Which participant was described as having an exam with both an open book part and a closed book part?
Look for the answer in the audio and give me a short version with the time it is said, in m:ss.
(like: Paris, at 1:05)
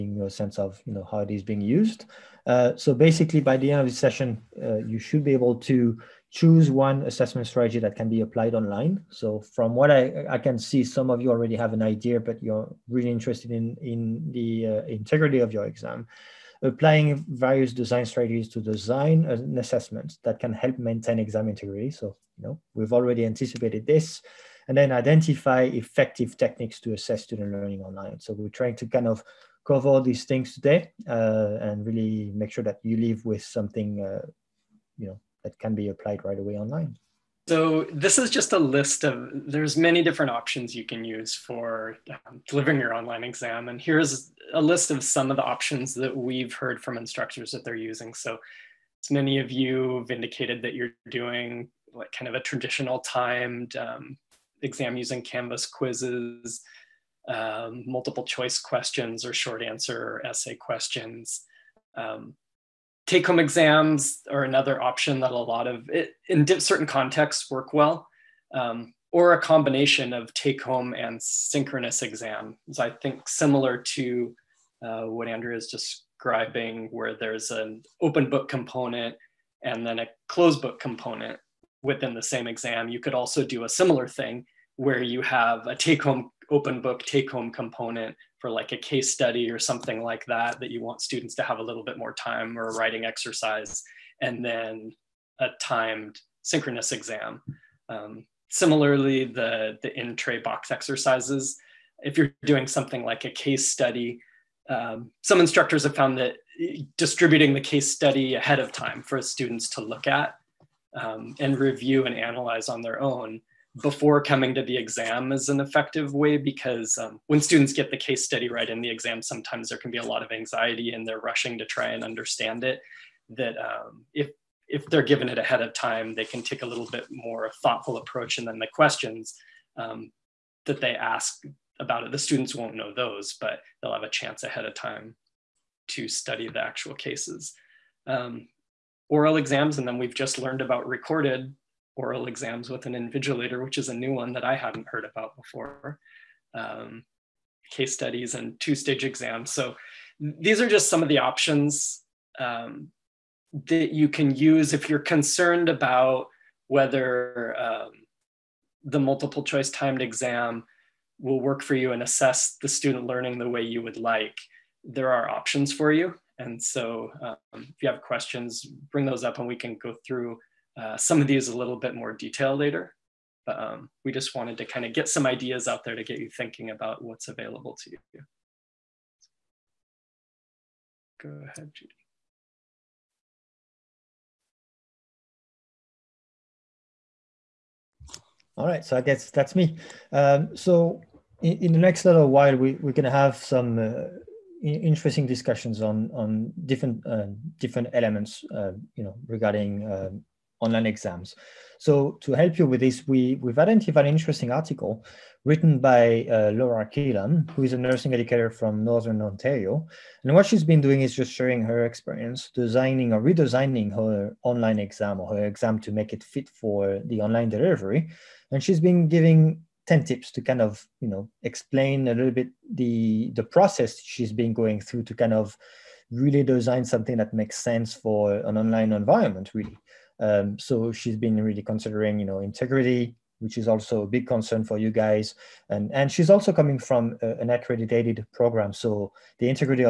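Andrea, at 1:15.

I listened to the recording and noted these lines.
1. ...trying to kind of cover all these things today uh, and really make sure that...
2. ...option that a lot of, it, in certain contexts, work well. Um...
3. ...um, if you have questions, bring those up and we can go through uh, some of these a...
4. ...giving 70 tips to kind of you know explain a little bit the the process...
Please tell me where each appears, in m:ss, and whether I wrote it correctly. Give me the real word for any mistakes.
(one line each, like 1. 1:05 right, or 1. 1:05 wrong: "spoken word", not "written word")
1. 0:28 right
2. 1:04 right
3. 2:47 right
4. 3:39 wrong: "10", not "70".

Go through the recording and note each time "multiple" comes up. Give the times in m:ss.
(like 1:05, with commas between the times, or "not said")
0:57, 2:38.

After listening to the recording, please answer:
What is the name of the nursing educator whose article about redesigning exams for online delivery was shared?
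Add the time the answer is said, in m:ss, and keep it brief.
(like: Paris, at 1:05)
Laura Keelan, at 3:26.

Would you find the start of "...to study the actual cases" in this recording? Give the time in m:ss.
2:15.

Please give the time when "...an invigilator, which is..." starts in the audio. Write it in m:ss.
2:22.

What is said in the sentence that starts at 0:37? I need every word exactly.
So this is just a list of, there's many different options you can use for um, delivering your online exam.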